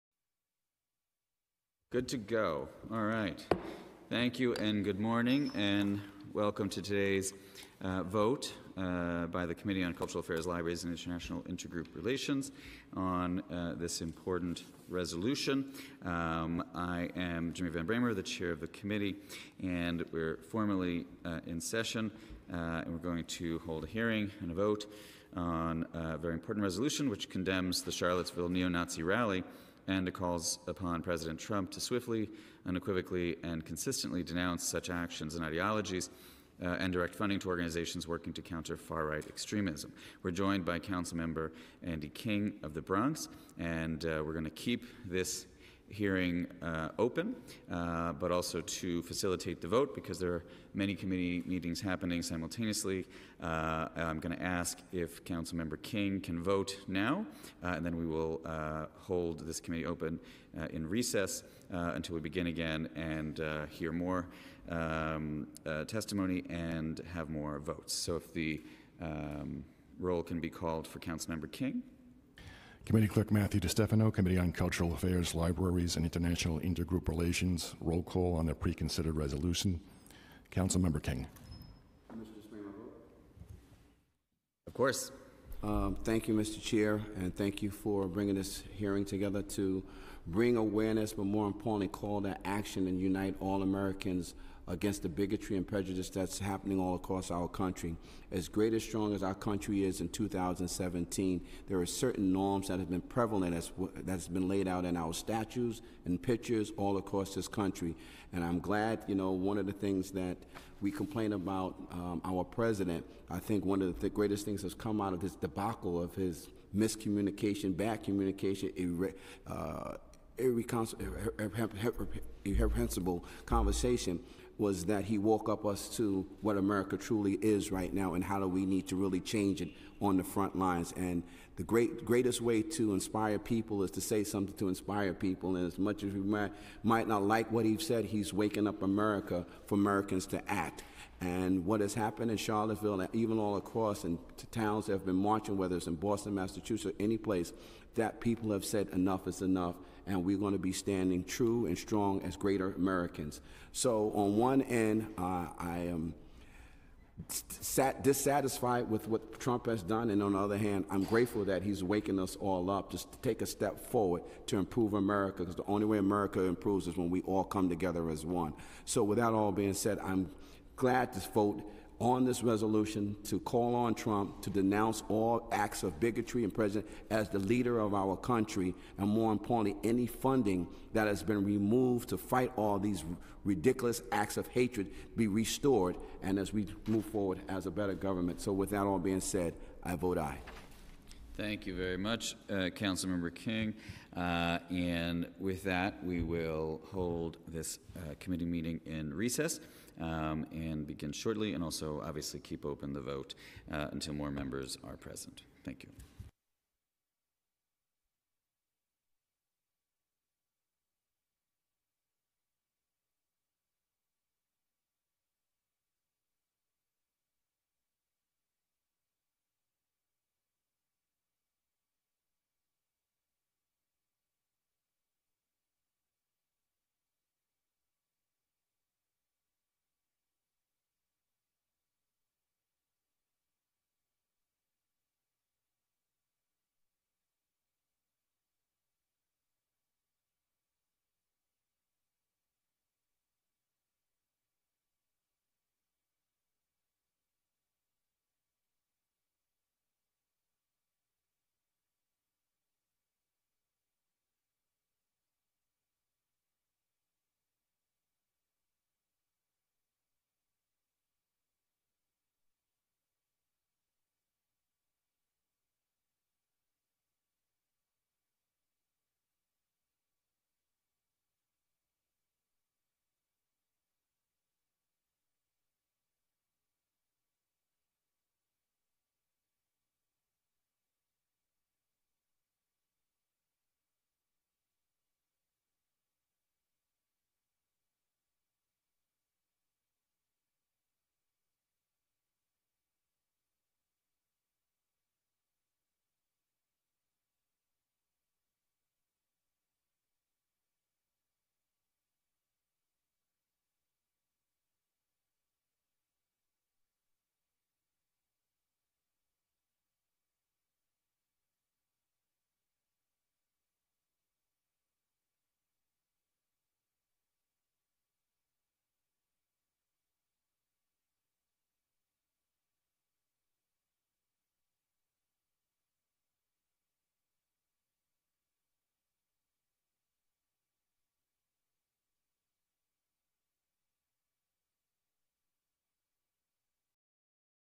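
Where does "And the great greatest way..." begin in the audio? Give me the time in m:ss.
2:10.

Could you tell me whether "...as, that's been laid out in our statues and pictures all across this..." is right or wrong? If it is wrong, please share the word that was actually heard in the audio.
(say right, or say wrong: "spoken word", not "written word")
right.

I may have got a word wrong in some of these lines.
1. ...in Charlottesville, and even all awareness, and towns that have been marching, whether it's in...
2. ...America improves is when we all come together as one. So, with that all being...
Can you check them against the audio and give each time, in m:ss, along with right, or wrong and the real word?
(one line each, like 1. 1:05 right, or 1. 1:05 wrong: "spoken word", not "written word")
1. 2:22 wrong: "across", not "awareness"
2. 2:45 right.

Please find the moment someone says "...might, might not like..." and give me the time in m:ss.
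2:16.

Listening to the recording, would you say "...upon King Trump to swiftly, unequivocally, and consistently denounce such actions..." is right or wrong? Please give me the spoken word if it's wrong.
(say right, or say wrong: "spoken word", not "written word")
wrong: "President", not "King".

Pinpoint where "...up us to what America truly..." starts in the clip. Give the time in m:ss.
2:05.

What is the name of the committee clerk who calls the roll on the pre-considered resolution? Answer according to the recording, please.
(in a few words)
Matthew DeStefano.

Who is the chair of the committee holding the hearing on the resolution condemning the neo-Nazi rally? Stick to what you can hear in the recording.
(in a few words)
Jimmy Van Bramer.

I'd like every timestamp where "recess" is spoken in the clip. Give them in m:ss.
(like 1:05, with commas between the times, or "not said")
1:00, 3:19.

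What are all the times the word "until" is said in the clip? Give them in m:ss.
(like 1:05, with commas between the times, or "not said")
1:01, 3:23.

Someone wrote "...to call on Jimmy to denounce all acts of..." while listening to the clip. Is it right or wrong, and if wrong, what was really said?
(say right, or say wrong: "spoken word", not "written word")
wrong: "Trump", not "Jimmy".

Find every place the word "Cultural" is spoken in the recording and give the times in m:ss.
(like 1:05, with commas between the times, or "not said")
0:09, 1:14.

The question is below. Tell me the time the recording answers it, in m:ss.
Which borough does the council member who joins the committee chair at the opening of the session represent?
0:42.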